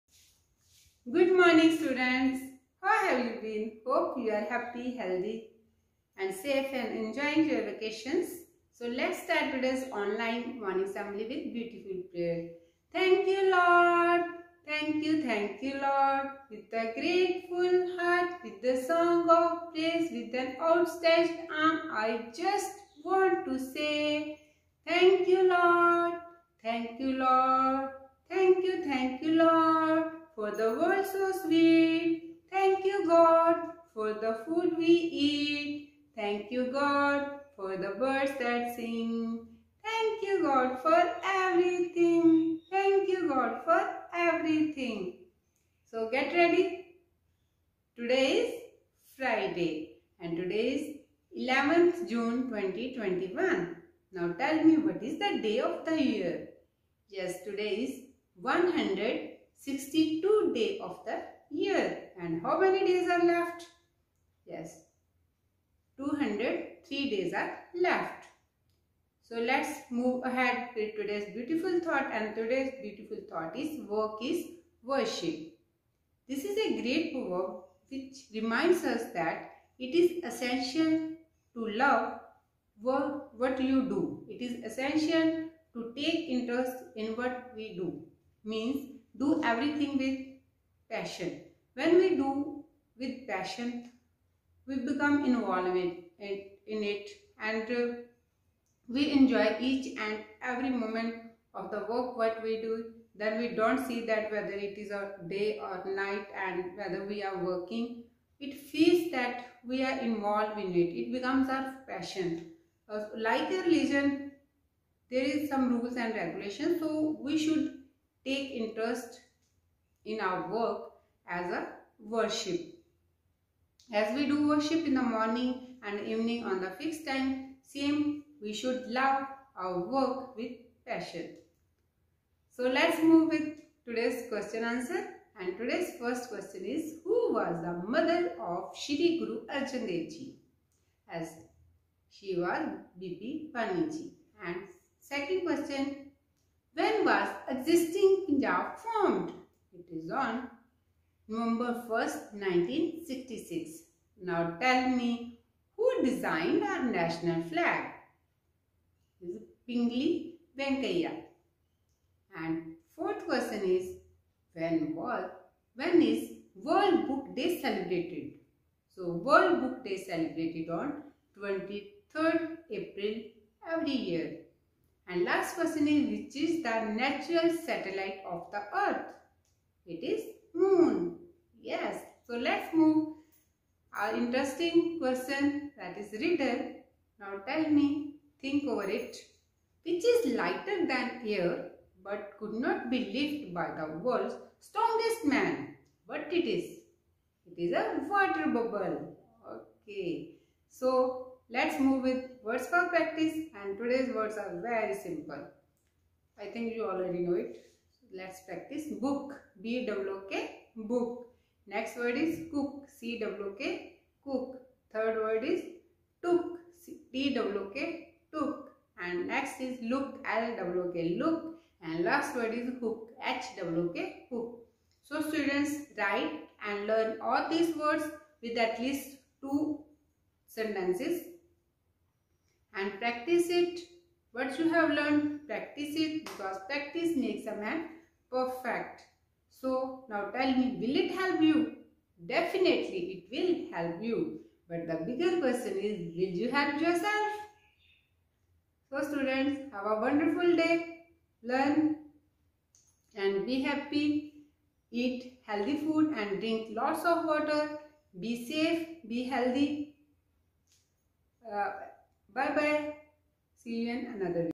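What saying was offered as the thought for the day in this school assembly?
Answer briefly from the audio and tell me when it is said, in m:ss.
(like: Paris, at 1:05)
Work is worship, at 1:13.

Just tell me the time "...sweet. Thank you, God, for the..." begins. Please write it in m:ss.
0:31.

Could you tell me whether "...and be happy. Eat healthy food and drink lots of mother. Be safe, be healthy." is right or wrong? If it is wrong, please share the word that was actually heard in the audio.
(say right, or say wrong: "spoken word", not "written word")
wrong: "water", not "mother".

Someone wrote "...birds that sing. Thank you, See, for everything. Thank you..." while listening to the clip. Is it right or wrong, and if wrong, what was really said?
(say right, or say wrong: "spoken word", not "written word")
wrong: "God", not "See".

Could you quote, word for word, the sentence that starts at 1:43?
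Then we don't see that whether it is a day or night and whether we are working.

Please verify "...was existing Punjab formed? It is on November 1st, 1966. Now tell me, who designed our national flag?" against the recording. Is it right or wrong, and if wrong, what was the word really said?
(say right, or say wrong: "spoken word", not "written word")
right.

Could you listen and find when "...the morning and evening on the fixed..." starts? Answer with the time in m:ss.
2:04.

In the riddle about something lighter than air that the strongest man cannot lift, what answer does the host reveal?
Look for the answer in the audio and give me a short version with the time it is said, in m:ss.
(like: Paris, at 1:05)
A water bubble, at 3:18.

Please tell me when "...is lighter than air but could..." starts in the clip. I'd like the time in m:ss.
3:10.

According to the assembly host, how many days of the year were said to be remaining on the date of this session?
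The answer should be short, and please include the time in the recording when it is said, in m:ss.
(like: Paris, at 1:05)
203, at 1:05.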